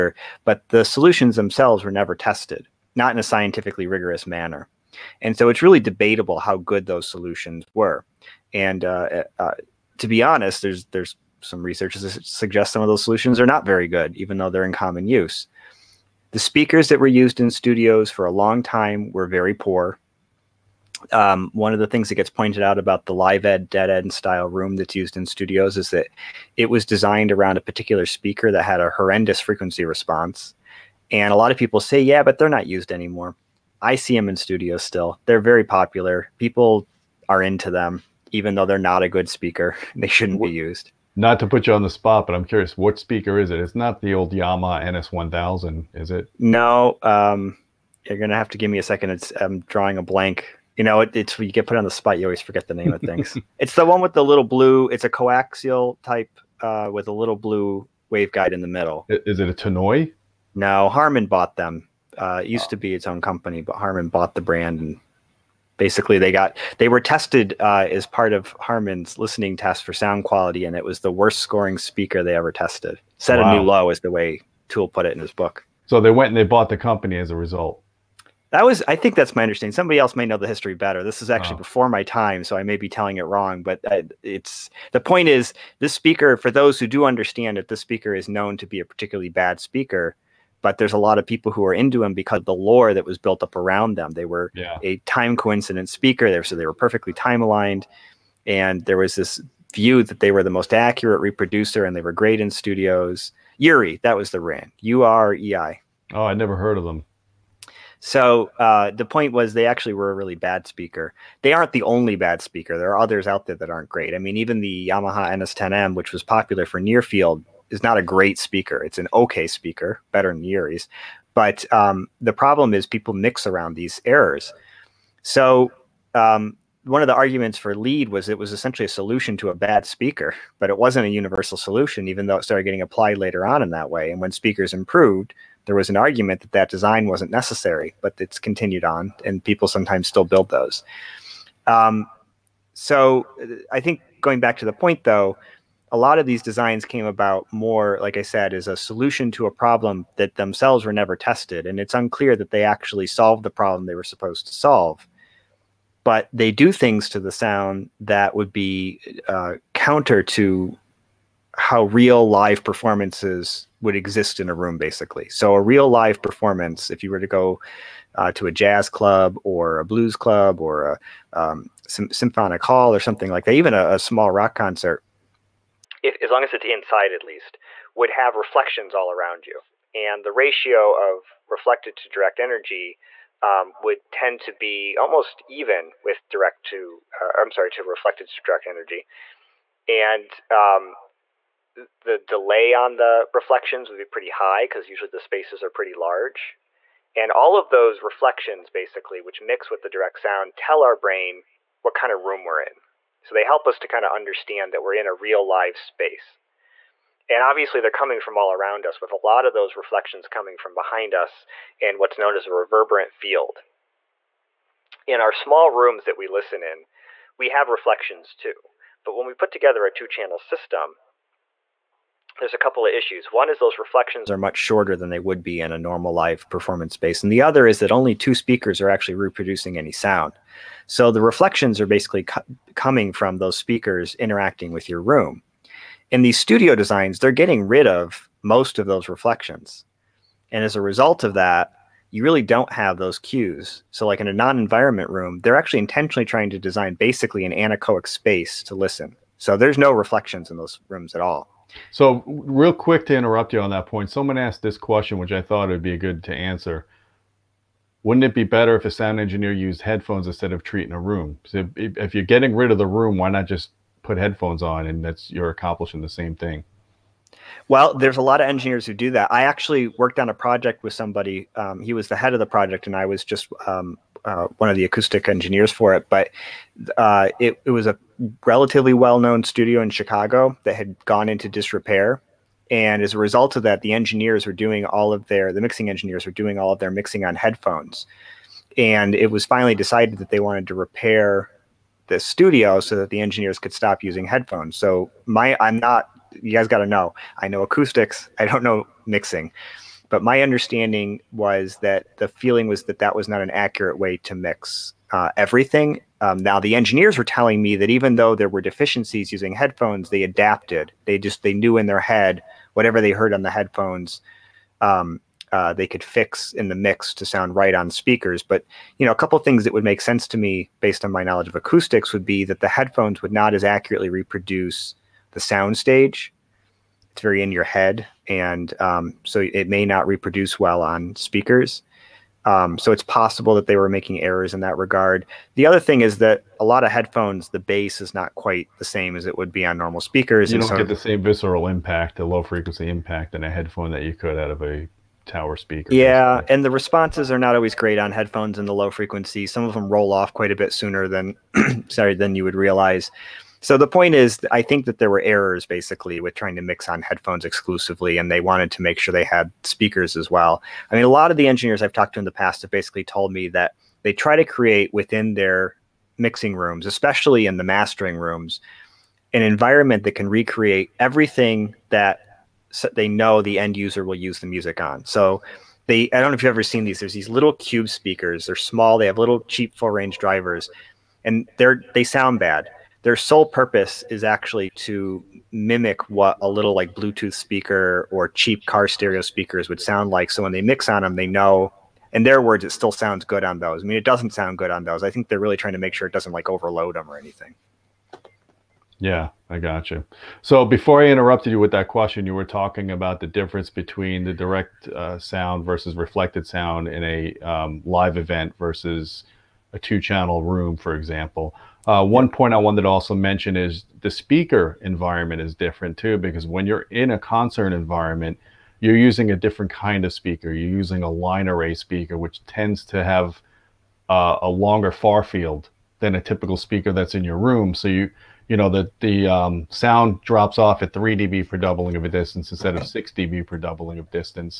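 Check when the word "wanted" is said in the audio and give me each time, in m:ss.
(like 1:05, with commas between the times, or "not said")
4:50, 5:58, 6:52.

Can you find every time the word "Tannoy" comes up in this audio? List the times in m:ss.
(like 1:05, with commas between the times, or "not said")
0:59.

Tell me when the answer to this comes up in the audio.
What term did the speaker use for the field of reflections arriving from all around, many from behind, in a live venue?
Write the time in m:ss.
3:32.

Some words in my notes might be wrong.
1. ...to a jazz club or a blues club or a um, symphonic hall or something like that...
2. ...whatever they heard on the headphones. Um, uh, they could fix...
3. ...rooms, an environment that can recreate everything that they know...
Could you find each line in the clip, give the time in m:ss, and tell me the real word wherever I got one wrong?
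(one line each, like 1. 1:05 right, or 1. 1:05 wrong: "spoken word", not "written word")
1. 2:48 right
2. 5:12 right
3. 6:08 right.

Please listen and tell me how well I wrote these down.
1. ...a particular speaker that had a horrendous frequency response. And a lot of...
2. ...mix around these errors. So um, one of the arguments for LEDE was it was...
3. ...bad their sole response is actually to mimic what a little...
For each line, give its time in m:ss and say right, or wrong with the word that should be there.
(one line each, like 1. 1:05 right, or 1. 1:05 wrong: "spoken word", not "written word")
1. 0:27 right
2. 2:03 right
3. 6:22 wrong: "purpose", not "response".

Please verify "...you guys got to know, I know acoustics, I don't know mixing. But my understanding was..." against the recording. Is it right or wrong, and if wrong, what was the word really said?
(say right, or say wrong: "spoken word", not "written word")
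right.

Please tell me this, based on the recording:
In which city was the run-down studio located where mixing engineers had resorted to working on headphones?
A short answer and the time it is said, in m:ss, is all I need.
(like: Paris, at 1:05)
Chicago, at 4:39.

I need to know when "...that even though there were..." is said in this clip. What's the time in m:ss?
5:07.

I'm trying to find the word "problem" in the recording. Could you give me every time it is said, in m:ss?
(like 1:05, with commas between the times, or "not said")
2:02, 2:29, 2:33.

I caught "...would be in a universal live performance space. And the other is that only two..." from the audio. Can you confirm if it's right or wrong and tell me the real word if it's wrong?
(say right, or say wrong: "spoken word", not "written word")
wrong: "normal", not "universal".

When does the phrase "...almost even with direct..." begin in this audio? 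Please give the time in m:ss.
3:04.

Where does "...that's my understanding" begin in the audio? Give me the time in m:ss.
1:19.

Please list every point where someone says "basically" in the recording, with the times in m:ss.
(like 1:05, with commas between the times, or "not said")
1:05, 2:44, 3:18, 3:51, 4:06, 5:55, 6:02.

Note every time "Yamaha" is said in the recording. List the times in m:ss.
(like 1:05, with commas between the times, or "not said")
0:44, 1:54.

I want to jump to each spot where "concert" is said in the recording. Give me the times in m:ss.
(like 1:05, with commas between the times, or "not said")
2:54, 6:57.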